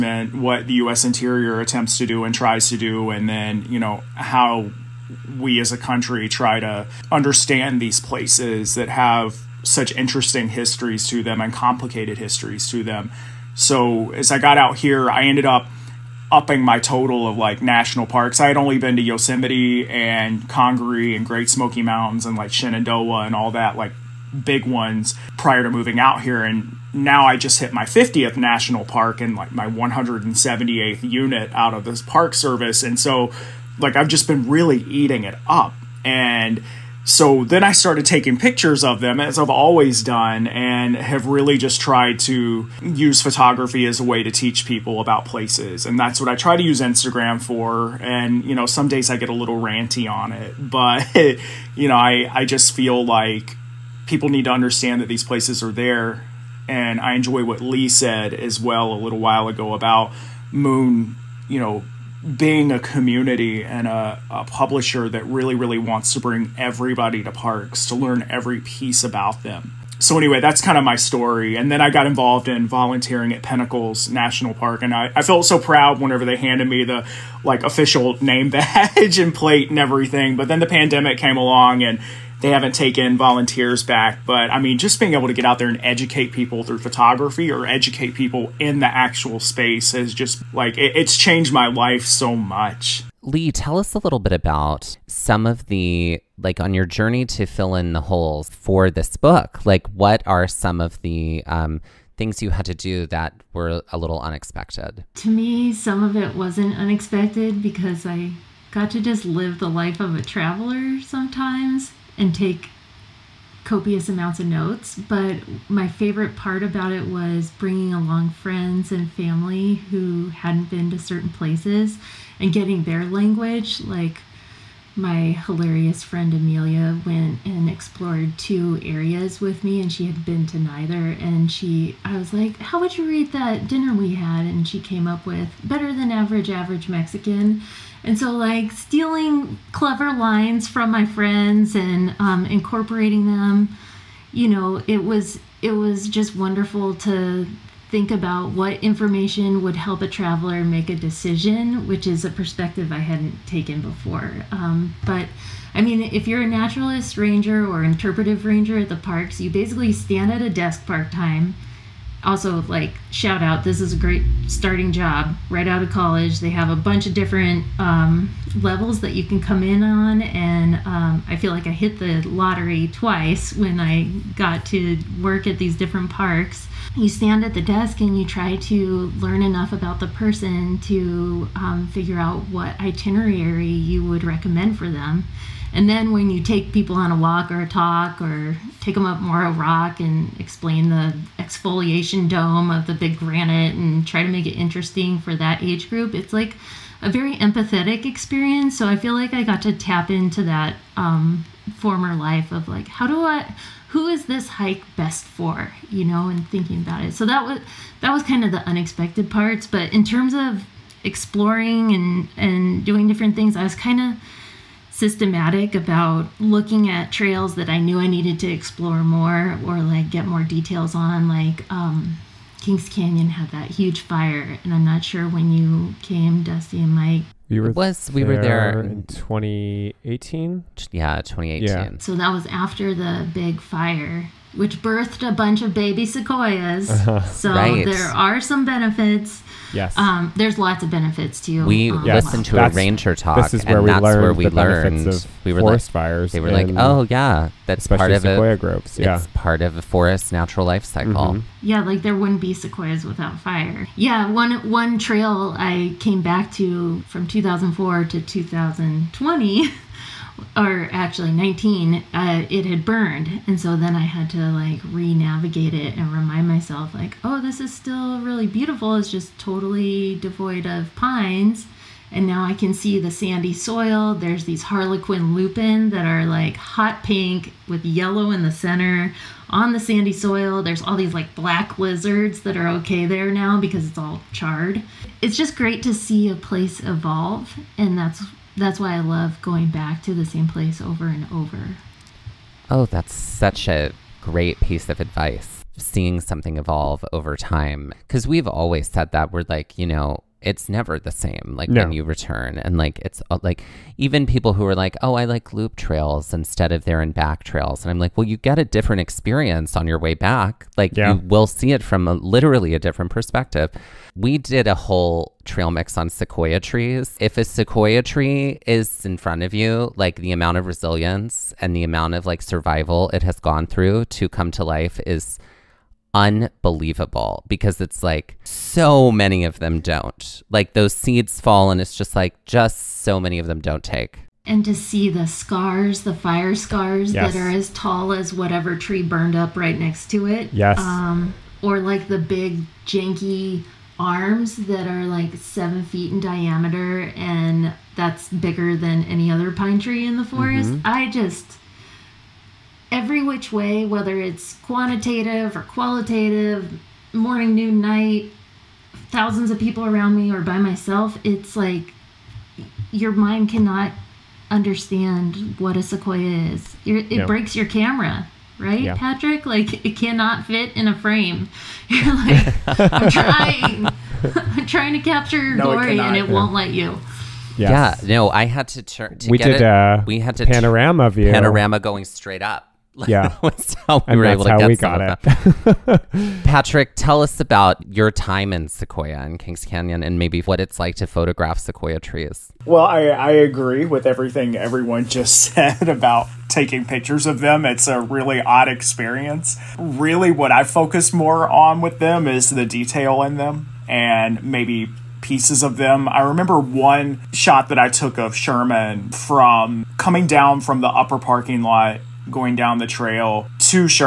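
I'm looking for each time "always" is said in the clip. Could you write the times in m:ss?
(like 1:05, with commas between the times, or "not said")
0:39, 4:58.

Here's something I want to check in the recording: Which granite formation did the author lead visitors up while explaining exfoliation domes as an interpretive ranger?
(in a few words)
Moro Rock.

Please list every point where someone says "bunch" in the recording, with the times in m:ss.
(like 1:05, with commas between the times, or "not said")
2:46, 3:55.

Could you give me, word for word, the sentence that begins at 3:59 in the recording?
Um, there's lots of benefits to We um, yes.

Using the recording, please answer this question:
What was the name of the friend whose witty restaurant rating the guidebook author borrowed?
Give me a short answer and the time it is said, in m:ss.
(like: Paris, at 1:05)
Amelia, at 2:06.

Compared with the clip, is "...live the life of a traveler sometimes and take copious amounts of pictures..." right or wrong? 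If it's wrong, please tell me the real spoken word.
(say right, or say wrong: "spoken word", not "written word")
wrong: "notes", not "pictures".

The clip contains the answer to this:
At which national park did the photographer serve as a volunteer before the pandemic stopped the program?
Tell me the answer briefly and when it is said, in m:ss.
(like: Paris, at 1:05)
Pinnacles National Park, at 1:13.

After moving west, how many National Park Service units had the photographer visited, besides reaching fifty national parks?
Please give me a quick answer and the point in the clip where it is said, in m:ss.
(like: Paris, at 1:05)
178, at 0:29.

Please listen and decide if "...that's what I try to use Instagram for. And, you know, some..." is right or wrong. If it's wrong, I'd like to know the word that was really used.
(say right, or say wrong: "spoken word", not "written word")
right.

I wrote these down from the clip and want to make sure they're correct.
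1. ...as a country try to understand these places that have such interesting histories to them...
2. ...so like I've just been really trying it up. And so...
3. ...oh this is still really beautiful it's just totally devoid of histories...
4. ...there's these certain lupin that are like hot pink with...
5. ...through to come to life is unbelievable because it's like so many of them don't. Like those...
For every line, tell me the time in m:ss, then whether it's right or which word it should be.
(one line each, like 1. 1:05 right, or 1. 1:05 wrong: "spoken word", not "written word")
1. 0:05 right
2. 0:32 wrong: "eating", not "trying"
3. 4:27 wrong: "pines", not "histories"
4. 4:34 wrong: "harlequin", not "certain"
5. 5:23 right.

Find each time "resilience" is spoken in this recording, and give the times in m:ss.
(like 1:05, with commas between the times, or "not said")
5:20.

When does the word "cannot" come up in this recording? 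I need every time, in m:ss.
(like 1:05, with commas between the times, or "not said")
6:03, 6:09.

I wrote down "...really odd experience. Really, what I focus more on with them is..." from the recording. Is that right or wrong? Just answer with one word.
right.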